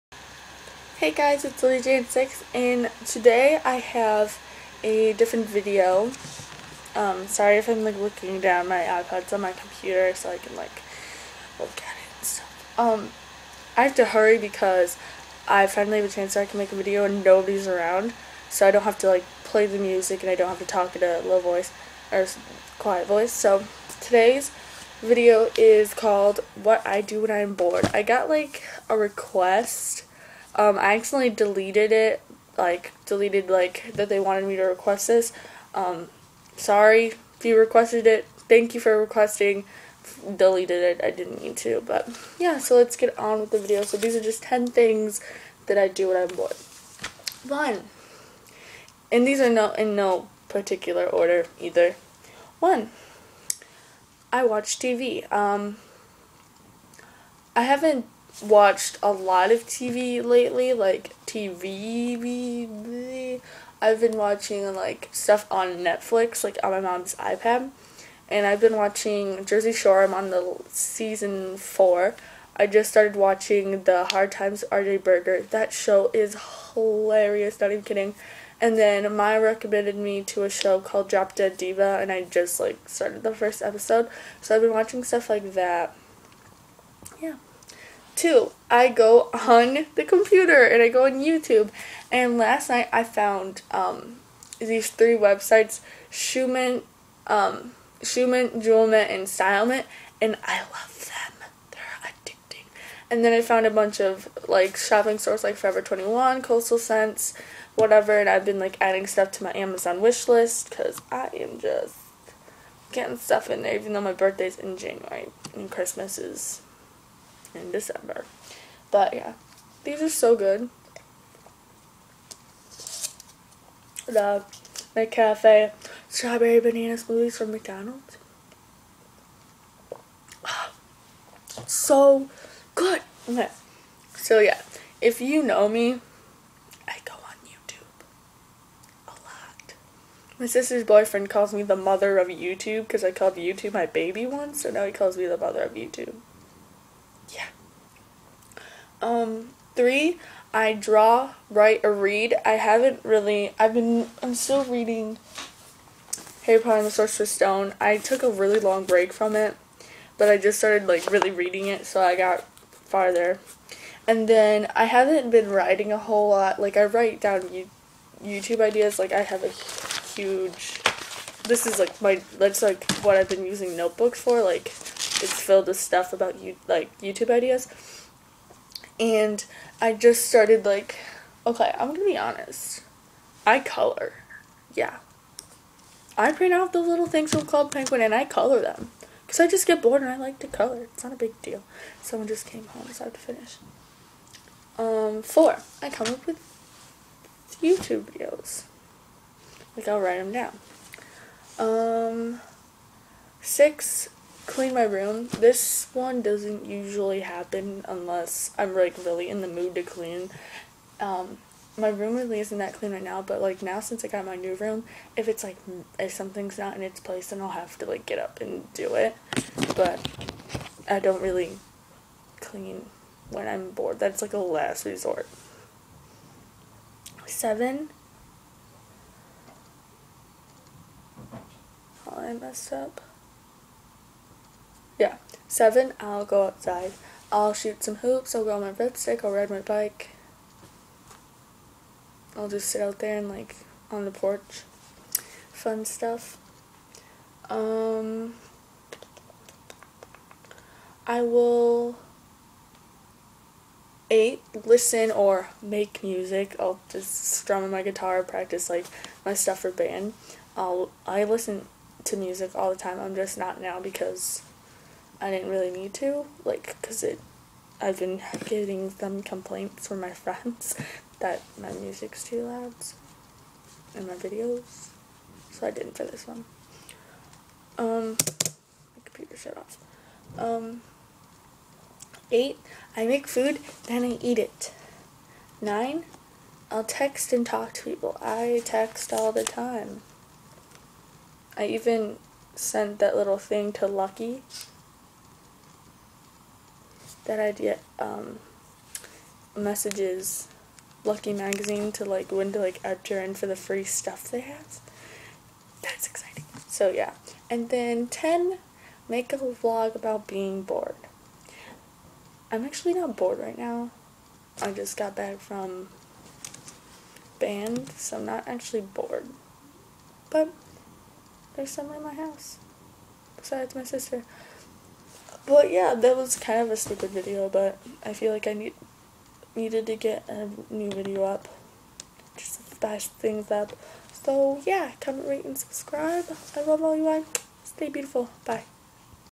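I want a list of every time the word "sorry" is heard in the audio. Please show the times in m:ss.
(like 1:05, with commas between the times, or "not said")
0:07, 0:36.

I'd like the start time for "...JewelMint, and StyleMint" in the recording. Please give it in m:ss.
1:38.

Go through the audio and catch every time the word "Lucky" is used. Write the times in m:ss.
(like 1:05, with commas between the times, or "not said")
4:53, 5:01.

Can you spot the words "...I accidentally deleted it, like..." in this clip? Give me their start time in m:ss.
0:30.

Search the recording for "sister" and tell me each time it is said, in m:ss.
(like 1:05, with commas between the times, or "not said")
2:20, 5:23.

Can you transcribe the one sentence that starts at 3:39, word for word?
But I don't really clean when I'm bored.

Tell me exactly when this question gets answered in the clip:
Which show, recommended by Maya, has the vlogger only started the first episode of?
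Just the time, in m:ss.
1:21.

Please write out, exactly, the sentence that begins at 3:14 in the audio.
Um, four, I come up with YouTube videos.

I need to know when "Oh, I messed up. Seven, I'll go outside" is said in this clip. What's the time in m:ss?
3:52.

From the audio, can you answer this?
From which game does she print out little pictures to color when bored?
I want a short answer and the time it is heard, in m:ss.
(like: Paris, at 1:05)
Club Penguin, at 3:07.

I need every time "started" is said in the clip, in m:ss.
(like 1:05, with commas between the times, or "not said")
1:12, 1:22, 2:40, 3:00.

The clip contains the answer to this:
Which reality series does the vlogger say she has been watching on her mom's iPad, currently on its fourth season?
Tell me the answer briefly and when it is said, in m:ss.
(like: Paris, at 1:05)
Jersey Shore, at 1:09.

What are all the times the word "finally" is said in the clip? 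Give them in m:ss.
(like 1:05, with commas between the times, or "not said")
0:15.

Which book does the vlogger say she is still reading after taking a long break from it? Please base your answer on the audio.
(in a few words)
Harry Potter and the Sorcerer's Stone.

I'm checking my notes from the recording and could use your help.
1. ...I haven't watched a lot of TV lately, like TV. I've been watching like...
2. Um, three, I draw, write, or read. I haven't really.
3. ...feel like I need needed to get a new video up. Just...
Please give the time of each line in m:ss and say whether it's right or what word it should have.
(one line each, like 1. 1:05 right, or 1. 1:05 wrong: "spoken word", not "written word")
1. 0:57 right
2. 2:29 right
3. 5:28 right.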